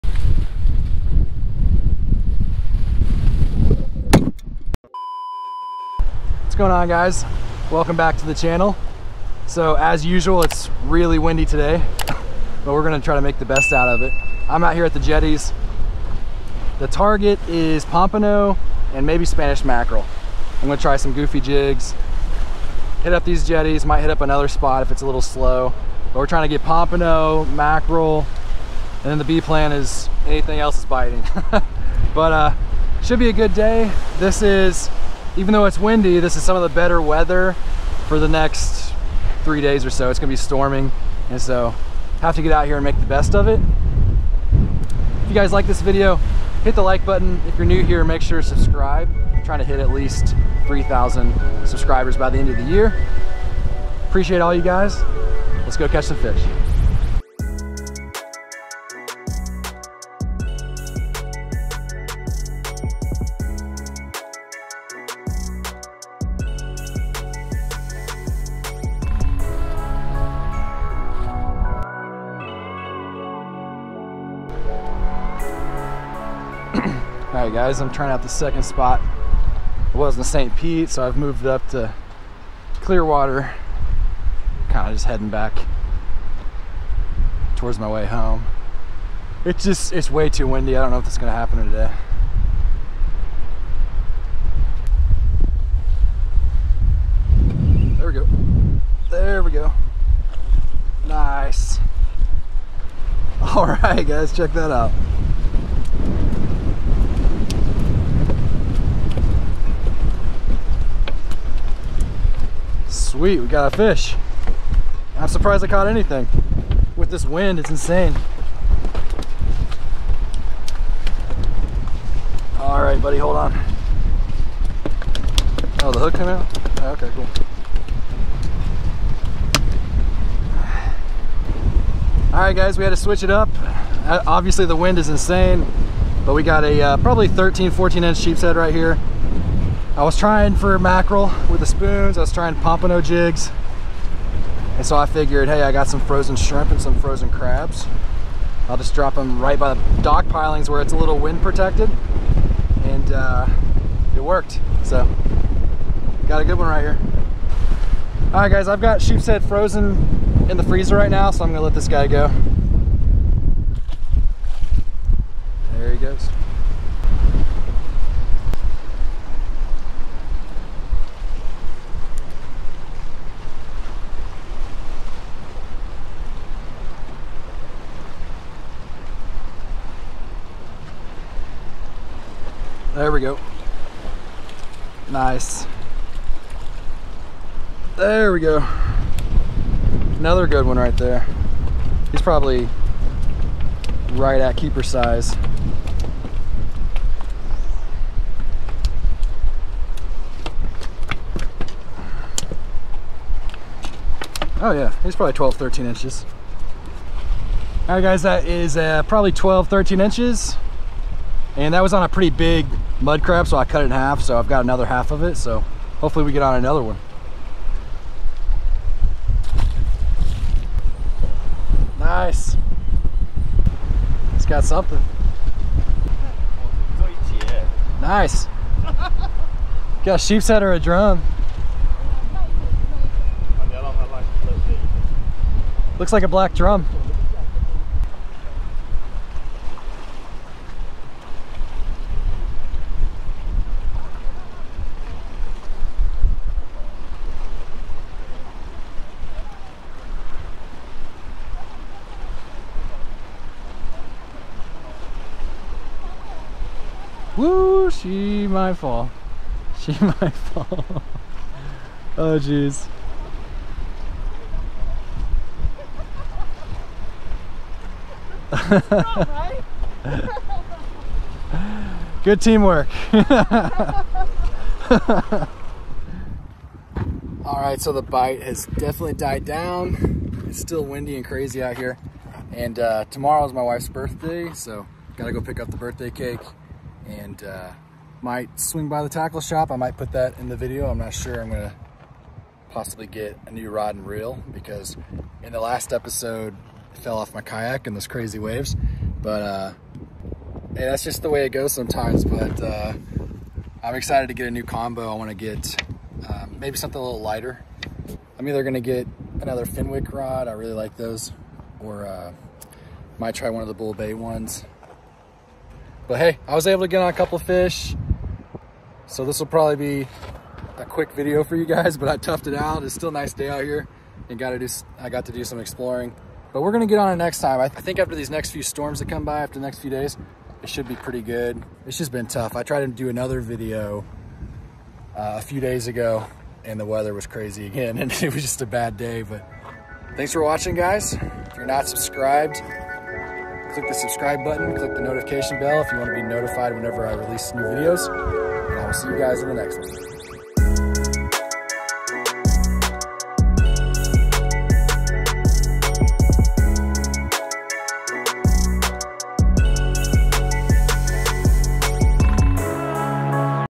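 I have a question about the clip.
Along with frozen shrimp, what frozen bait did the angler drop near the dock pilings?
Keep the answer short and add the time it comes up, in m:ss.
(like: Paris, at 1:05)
Frozen crabs, at 2:26.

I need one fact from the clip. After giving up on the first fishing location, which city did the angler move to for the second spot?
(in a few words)
Clearwater.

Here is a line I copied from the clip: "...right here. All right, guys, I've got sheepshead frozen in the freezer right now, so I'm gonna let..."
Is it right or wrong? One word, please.
right.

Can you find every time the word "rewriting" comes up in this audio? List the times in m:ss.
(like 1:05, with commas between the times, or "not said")
not said.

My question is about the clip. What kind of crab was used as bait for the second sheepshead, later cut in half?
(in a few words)
Mud crab.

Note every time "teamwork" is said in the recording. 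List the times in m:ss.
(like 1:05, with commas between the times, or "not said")
4:32.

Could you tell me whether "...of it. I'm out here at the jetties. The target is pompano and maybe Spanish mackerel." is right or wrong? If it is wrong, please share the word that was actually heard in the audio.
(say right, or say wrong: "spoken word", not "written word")
right.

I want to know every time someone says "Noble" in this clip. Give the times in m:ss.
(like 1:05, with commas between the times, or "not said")
not said.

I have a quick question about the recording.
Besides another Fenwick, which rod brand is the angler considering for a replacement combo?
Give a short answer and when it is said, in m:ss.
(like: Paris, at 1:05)
Bull Bay, at 5:13.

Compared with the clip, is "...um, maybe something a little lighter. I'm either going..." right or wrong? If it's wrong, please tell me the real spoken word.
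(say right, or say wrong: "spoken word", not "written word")
right.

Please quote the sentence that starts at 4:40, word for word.
It's still windy and crazy out here.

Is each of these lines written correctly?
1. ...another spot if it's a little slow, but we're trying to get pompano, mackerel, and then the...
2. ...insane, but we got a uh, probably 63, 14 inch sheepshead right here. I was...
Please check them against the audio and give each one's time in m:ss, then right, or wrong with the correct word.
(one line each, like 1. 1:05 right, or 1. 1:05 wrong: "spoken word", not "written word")
1. 0:24 right
2. 2:15 wrong: "13", not "63".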